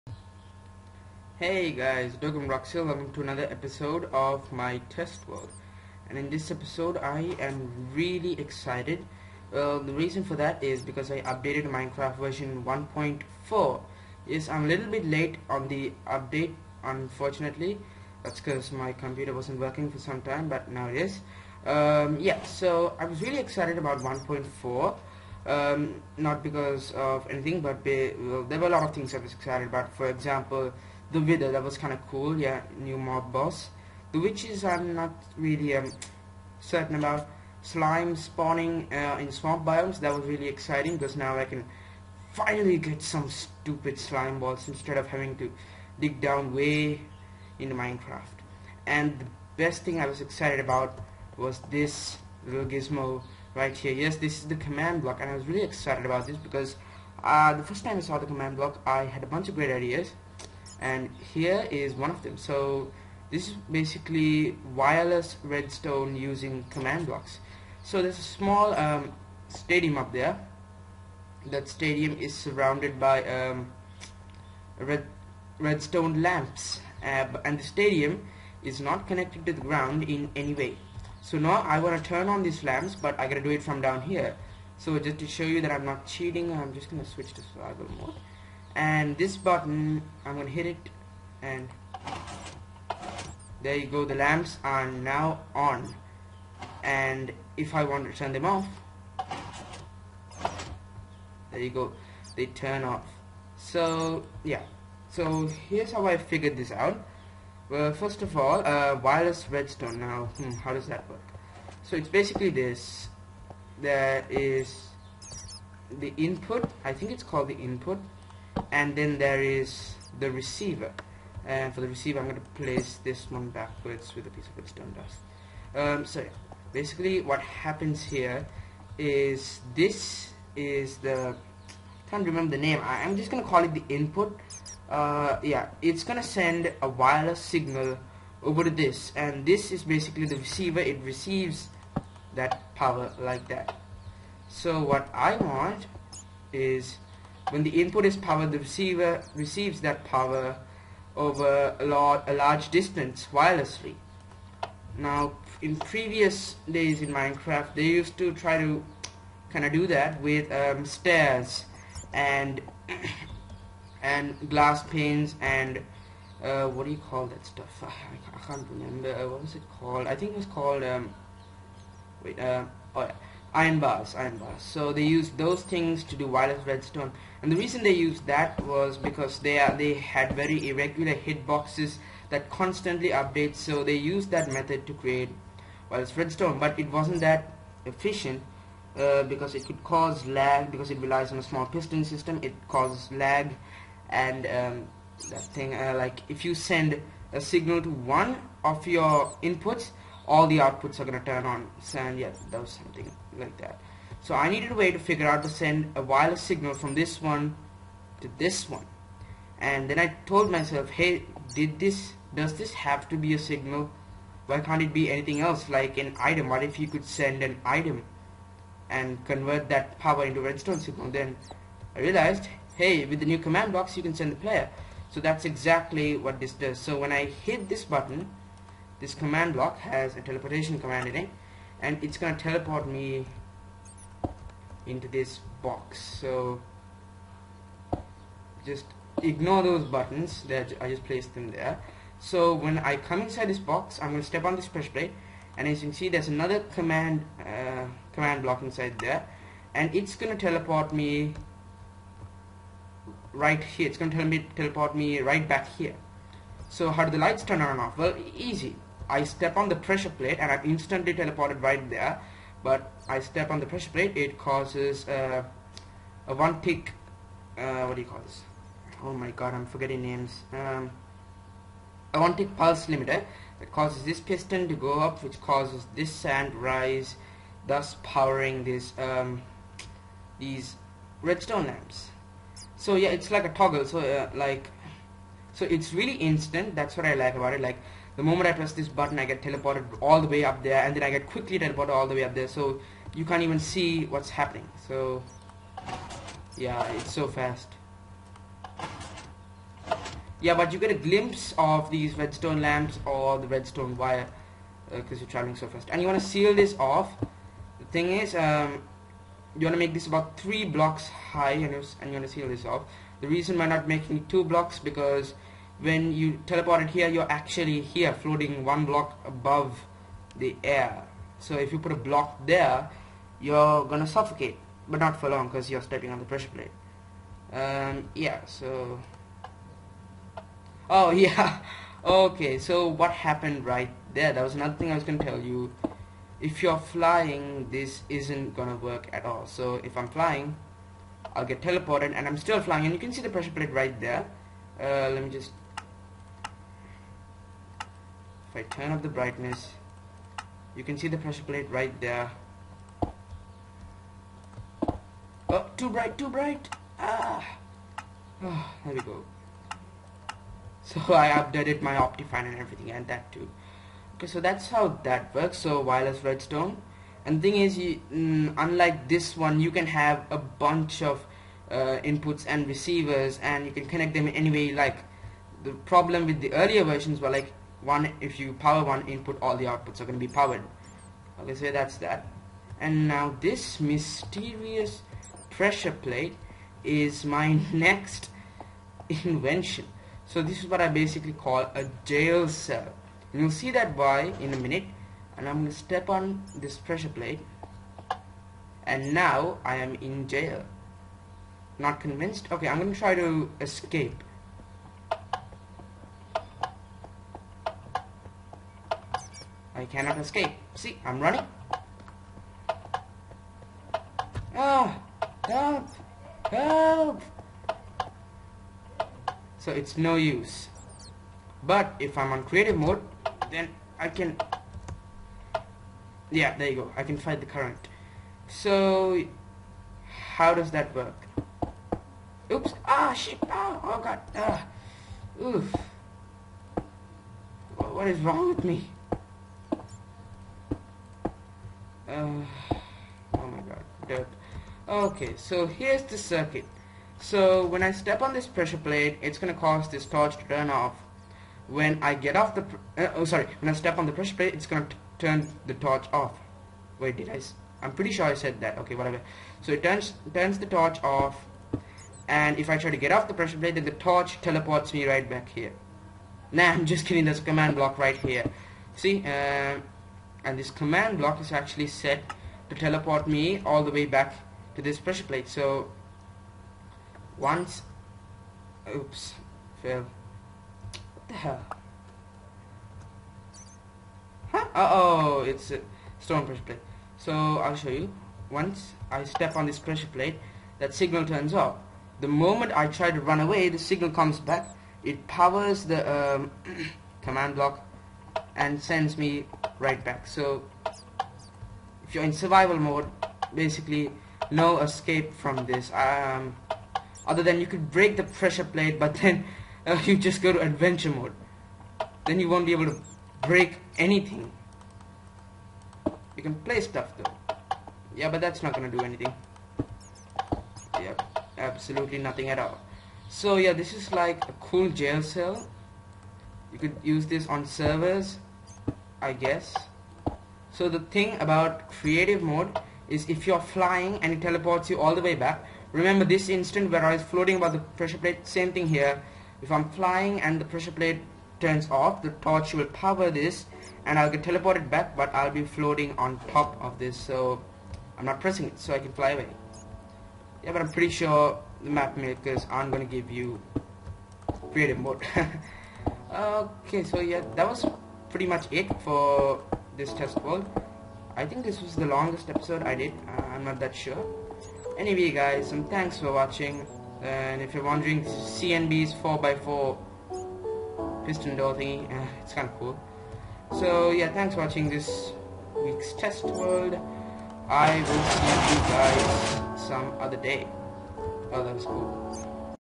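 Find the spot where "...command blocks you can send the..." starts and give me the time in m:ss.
3:43.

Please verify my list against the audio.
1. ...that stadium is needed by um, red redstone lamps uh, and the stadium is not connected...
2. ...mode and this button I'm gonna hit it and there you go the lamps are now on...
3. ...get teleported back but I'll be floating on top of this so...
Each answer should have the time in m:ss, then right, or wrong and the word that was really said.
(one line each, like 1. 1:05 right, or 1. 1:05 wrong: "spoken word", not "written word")
1. 1:11 wrong: "surrounded", not "needed"
2. 1:27 right
3. 9:04 right.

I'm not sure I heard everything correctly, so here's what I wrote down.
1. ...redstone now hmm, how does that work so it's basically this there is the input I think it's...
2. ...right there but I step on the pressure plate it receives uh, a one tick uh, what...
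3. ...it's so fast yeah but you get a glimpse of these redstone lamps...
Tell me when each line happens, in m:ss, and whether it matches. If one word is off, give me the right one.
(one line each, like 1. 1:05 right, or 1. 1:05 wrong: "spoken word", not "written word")
1. 1:49 right
2. 4:21 wrong: "causes", not "receives"
3. 4:56 right.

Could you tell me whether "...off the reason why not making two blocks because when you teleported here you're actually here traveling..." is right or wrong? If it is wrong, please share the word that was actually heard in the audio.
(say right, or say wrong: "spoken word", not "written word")
wrong: "floating", not "traveling".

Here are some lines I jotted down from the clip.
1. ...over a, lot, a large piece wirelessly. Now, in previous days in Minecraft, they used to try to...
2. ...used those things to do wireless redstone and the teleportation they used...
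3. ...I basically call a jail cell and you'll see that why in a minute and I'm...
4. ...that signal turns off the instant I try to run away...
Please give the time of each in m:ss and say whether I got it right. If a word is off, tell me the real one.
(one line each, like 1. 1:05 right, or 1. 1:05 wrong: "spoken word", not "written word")
1. 2:31 wrong: "distance", not "piece"
2. 2:55 wrong: "reason", not "teleportation"
3. 6:30 right
4. 8:10 wrong: "moment", not "instant".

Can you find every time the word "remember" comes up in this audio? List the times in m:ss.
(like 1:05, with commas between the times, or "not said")
2:12, 2:48, 8:55.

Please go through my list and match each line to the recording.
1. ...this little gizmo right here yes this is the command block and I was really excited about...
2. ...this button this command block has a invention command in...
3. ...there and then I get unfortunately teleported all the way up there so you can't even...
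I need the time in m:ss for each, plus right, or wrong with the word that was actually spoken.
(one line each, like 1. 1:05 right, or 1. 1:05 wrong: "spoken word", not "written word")
1. 0:51 right
2. 3:47 wrong: "teleportation", not "invention"
3. 4:50 wrong: "quickly", not "unfortunately".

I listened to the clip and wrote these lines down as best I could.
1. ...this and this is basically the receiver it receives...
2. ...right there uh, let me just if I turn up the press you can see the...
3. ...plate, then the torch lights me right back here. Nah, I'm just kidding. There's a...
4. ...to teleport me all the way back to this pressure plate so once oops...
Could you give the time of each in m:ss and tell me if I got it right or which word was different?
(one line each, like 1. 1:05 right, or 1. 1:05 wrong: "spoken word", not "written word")
1. 2:18 right
2. 5:43 wrong: "brightness", not "press"
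3. 7:43 wrong: "teleports", not "lights"
4. 7:52 right.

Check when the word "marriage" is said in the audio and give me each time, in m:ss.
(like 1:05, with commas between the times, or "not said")
not said.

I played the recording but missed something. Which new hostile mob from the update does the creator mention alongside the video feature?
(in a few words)
witches.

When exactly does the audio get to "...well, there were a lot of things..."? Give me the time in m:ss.
0:28.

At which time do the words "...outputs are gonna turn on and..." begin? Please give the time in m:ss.
3:20.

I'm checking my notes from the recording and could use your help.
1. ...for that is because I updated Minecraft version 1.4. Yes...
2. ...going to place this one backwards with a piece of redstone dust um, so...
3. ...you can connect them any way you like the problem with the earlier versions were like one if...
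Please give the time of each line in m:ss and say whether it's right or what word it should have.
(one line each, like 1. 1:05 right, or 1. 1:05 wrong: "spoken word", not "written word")
1. 0:10 right
2. 2:02 right
3. 6:13 right.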